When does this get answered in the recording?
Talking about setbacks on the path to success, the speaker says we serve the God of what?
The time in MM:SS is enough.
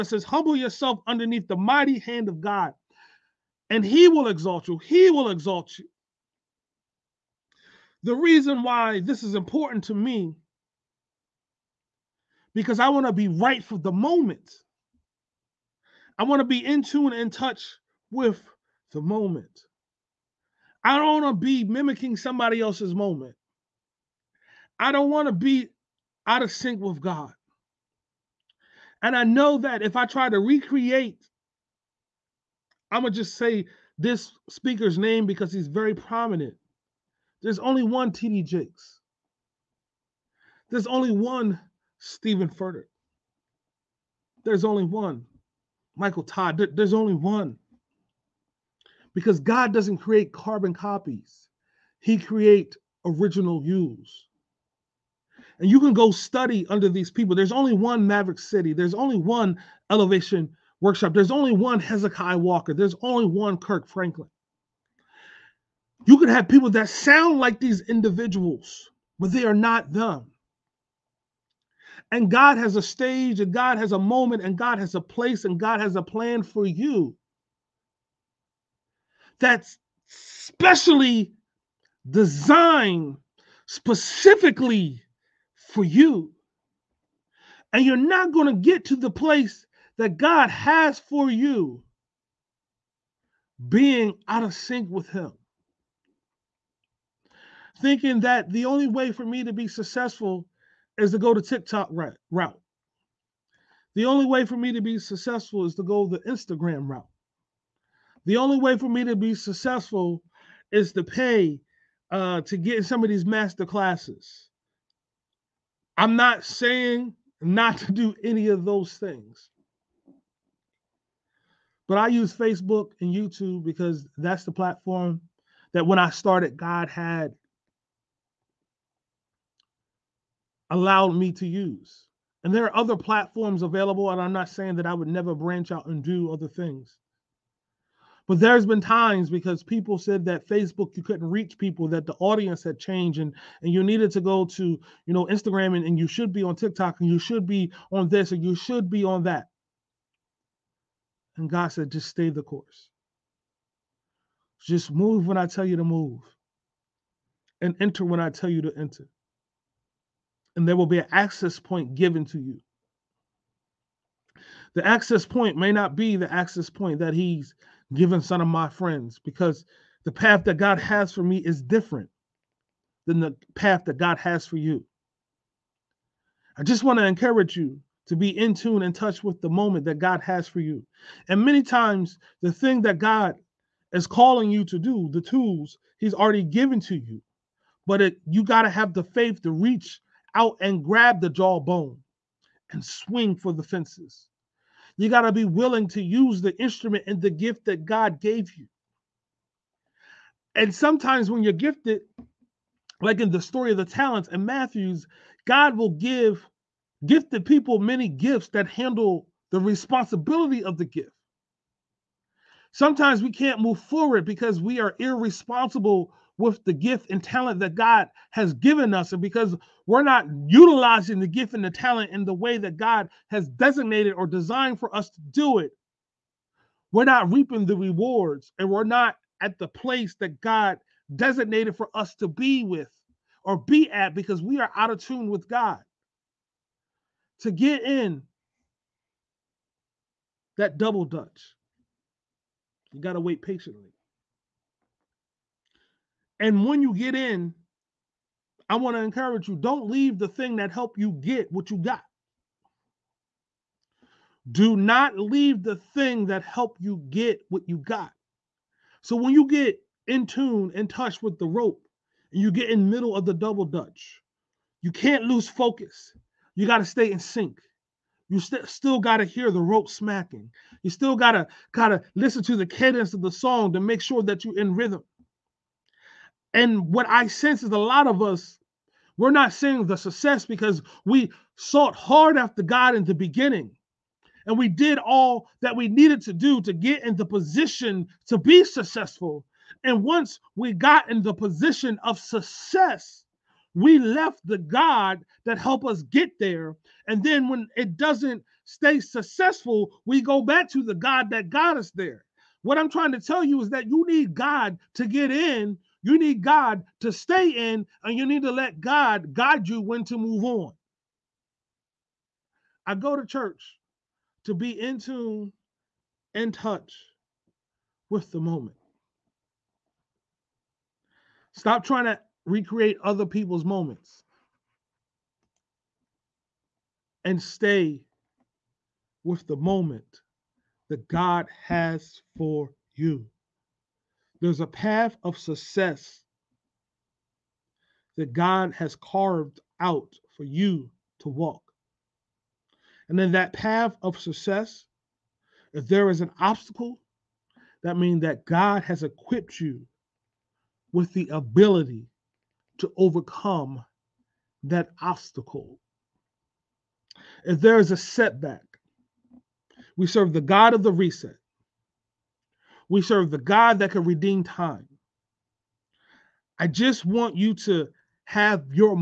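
06:00.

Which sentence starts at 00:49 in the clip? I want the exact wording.
Because God doesn't create carbon copies.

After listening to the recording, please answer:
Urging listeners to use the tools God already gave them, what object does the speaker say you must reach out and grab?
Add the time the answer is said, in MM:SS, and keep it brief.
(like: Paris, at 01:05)
Jawbone, at 03:11.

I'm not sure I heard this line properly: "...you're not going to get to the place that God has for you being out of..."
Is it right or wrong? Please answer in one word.
right.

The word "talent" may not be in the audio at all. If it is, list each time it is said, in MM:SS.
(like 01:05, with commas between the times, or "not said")
03:23, 03:37, 03:41.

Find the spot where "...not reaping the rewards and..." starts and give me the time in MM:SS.
03:47.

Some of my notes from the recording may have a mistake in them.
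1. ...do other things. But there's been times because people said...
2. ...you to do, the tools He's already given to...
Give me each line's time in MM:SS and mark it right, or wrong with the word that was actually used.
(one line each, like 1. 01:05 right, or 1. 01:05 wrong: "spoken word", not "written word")
1. 02:16 right
2. 03:04 right.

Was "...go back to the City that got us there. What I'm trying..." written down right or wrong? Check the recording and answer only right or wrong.
wrong.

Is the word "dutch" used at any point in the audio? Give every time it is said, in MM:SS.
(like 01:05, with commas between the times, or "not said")
04:01, 04:23.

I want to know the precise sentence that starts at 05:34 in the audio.
There's a path of success that God has carved out for you to walk.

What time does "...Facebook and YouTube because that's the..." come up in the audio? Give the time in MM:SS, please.
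02:02.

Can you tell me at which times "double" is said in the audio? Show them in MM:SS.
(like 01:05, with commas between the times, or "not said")
04:00, 04:23.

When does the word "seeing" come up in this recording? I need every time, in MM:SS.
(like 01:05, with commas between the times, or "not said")
04:39.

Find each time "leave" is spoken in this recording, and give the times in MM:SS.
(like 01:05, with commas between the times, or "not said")
04:09, 04:15.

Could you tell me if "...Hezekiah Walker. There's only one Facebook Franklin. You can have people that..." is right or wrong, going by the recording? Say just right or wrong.
wrong.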